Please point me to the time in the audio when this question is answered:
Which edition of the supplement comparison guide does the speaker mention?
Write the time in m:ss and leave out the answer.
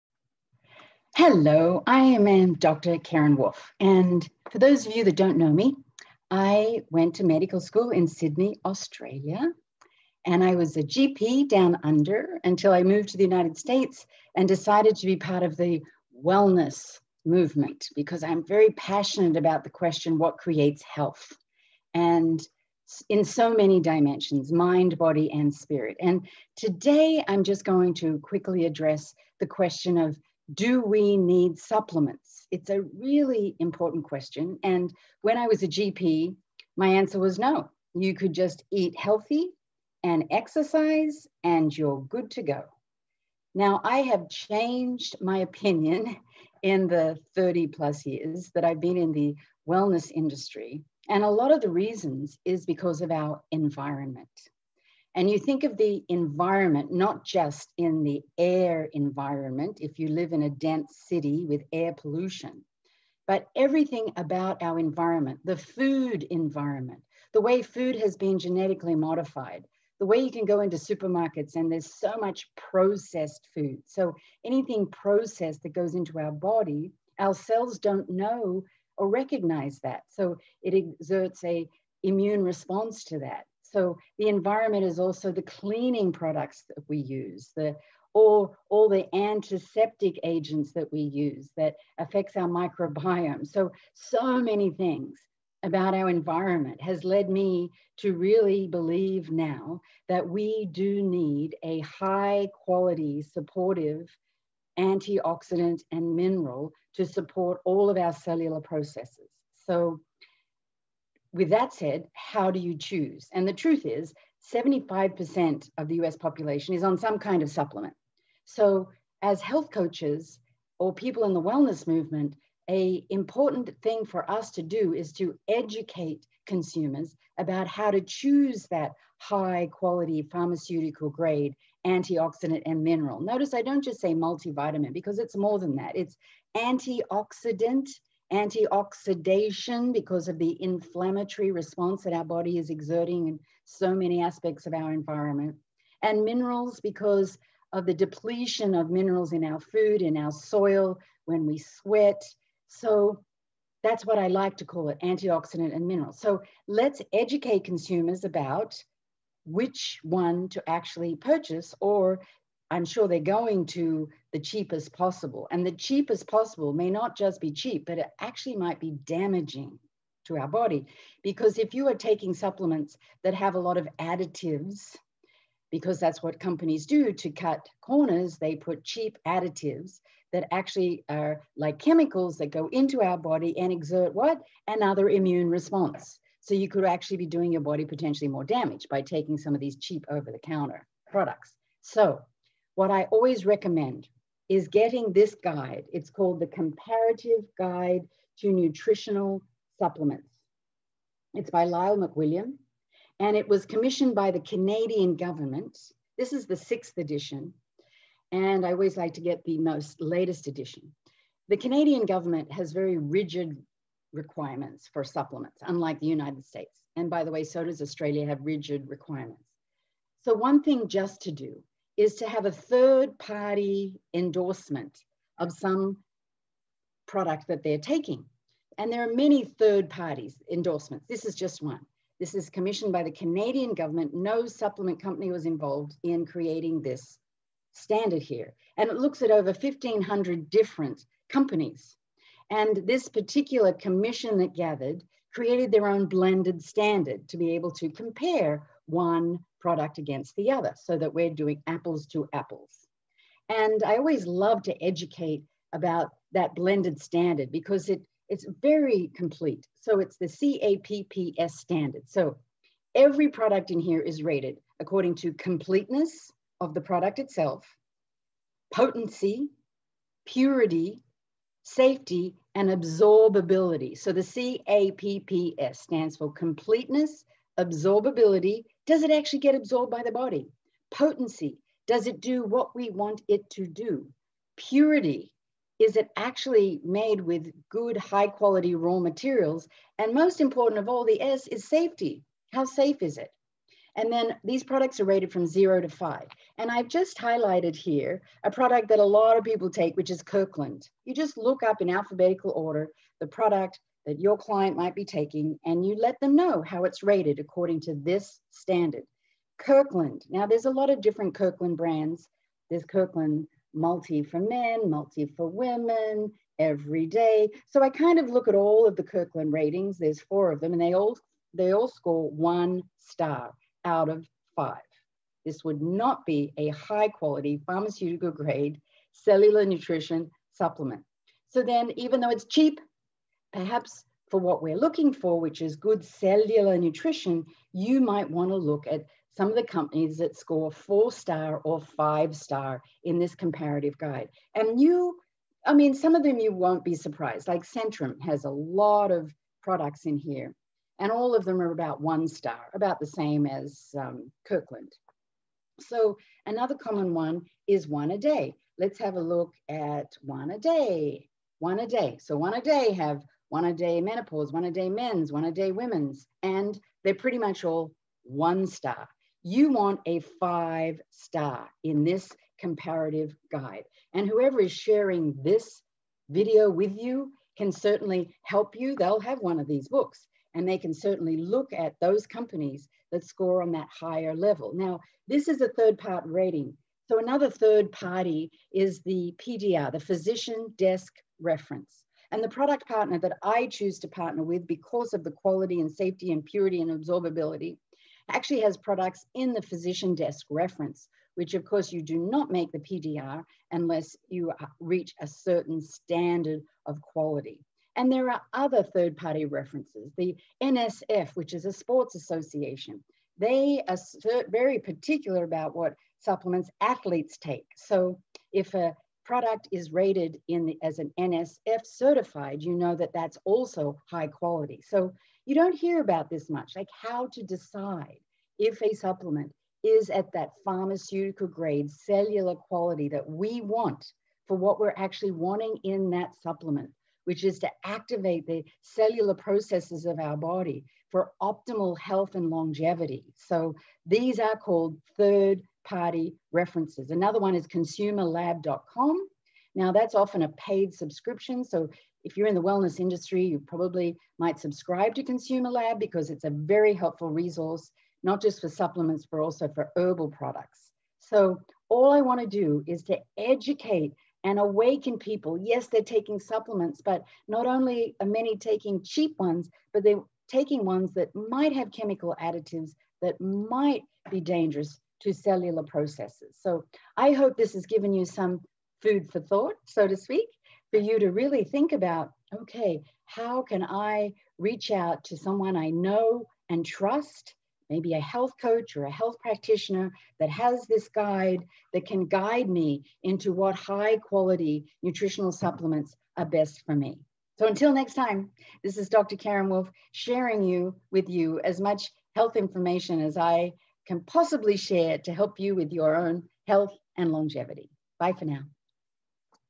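3:26.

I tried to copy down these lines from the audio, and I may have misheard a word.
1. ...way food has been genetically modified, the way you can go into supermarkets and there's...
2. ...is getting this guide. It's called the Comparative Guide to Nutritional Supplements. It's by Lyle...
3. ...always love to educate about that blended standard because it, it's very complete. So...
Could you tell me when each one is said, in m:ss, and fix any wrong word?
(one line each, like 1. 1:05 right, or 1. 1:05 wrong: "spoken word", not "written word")
1. 1:07 right
2. 3:14 right
3. 4:13 right.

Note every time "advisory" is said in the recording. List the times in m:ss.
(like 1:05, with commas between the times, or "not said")
not said.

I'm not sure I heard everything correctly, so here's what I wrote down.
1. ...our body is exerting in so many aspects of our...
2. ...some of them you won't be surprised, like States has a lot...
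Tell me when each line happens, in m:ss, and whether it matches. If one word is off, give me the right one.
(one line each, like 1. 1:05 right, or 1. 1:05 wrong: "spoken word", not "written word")
1. 2:22 right
2. 5:45 wrong: "Centrum", not "States".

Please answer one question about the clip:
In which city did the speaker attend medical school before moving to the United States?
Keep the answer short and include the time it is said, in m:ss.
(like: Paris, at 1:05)
Sydney, at 0:08.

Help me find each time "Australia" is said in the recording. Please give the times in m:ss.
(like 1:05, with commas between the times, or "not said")
0:08, 3:37.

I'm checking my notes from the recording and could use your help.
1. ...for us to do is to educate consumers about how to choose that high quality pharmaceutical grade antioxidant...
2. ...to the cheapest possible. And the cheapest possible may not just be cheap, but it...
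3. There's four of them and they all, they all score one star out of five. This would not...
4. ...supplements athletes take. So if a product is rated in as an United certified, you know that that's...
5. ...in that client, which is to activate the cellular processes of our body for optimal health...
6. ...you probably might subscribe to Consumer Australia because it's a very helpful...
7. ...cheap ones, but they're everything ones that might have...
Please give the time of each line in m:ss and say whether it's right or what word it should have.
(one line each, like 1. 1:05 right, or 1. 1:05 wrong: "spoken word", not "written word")
1. 2:04 right
2. 2:43 right
3. 5:19 right
4. 6:56 wrong: "NSF", not "United"
5. 7:15 wrong: "supplement", not "client"
6. 7:33 wrong: "Lab", not "Australia"
7. 7:49 wrong: "taking", not "everything".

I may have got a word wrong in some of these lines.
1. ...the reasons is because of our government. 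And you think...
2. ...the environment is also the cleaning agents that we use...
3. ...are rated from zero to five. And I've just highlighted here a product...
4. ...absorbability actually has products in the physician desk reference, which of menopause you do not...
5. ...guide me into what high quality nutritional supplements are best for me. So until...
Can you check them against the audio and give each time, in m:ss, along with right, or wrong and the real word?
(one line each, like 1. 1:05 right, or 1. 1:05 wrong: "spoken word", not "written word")
1. 0:51 wrong: "environment", not "government"
2. 1:24 wrong: "products", not "agents"
3. 4:54 right
4. 6:36 wrong: "course", not "menopause"
5. 8:12 right.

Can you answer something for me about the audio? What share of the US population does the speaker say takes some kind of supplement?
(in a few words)
75%.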